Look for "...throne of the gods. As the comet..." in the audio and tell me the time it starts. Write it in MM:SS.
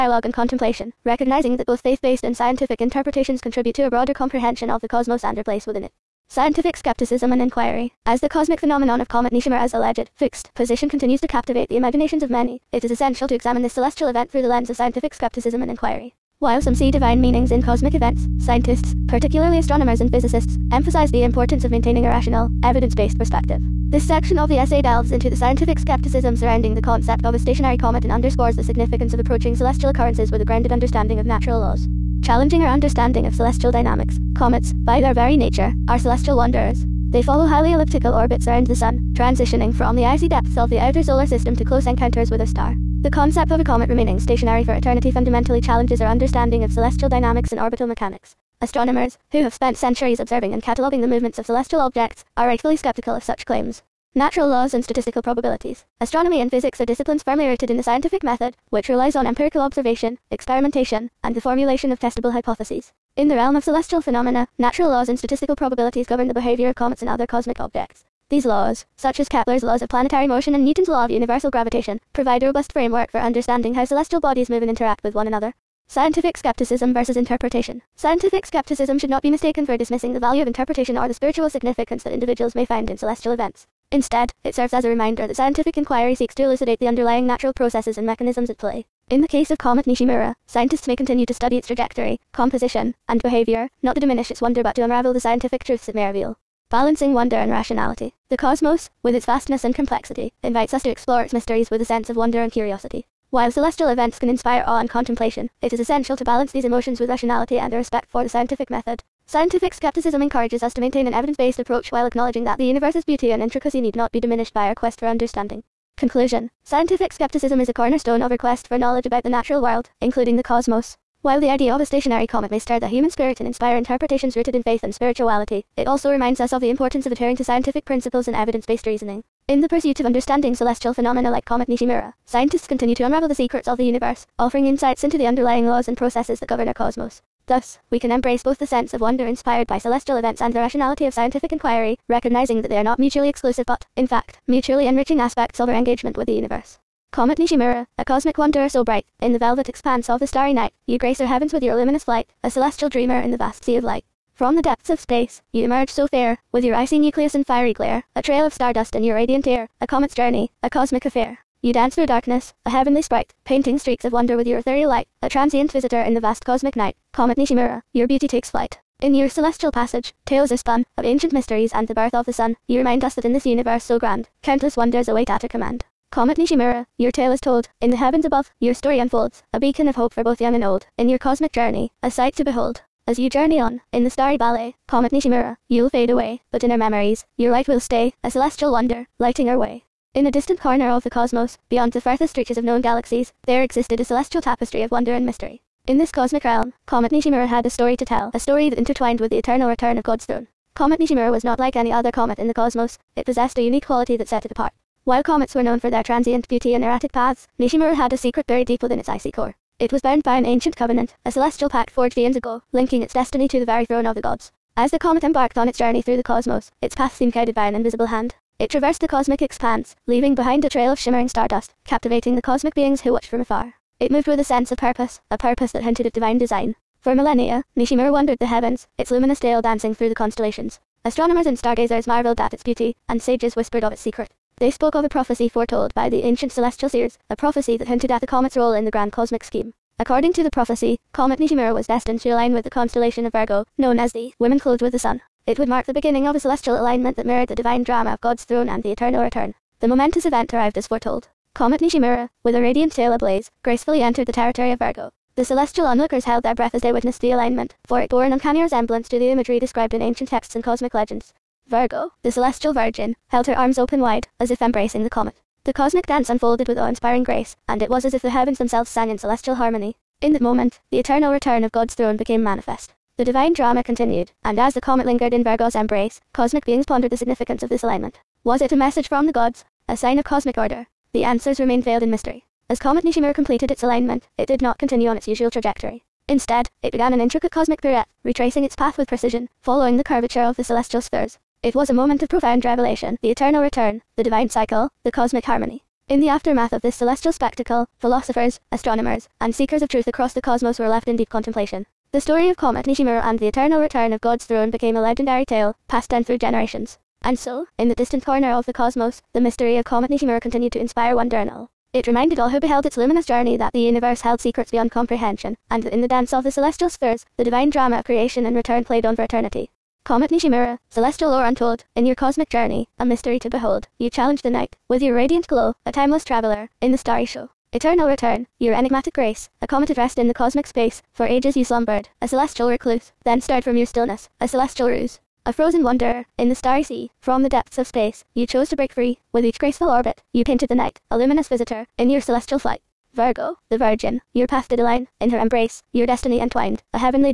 03:33.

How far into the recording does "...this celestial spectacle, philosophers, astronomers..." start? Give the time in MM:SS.
04:56.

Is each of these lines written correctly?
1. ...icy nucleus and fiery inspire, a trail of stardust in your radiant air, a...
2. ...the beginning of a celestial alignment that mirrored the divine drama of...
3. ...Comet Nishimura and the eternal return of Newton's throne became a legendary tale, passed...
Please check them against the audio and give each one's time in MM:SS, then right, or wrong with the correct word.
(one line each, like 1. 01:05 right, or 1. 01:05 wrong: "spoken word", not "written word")
1. 02:36 wrong: "glare", not "inspire"
2. 04:05 right
3. 05:02 wrong: "God", not "Newton".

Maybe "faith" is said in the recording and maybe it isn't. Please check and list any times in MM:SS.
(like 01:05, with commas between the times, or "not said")
00:01, 02:04.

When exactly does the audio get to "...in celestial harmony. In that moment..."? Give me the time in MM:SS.
04:29.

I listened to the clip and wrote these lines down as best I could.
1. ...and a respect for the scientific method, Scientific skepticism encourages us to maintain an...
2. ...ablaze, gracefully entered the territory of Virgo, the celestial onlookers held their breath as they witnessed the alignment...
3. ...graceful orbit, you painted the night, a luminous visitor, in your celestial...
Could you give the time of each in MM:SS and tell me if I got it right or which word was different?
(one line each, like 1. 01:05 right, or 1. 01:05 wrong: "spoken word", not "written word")
1. 01:47 right
2. 04:13 right
3. 05:39 right.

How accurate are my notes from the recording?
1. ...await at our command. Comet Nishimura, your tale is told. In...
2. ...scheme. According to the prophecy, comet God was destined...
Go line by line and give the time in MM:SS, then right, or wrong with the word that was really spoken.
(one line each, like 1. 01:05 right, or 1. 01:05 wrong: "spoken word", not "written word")
1. 02:55 right
2. 03:59 wrong: "Nishimura", not "God".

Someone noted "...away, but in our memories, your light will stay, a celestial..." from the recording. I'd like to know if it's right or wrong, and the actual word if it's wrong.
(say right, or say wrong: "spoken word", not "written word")
right.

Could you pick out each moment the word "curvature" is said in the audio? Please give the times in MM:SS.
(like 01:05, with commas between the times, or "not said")
04:50.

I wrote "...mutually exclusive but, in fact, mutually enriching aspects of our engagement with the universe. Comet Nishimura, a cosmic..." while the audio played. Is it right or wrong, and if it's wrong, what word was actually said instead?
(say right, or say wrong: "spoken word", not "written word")
right.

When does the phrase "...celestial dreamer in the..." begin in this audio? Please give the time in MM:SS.
02:32.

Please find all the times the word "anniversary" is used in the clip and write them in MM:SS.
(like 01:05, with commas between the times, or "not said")
not said.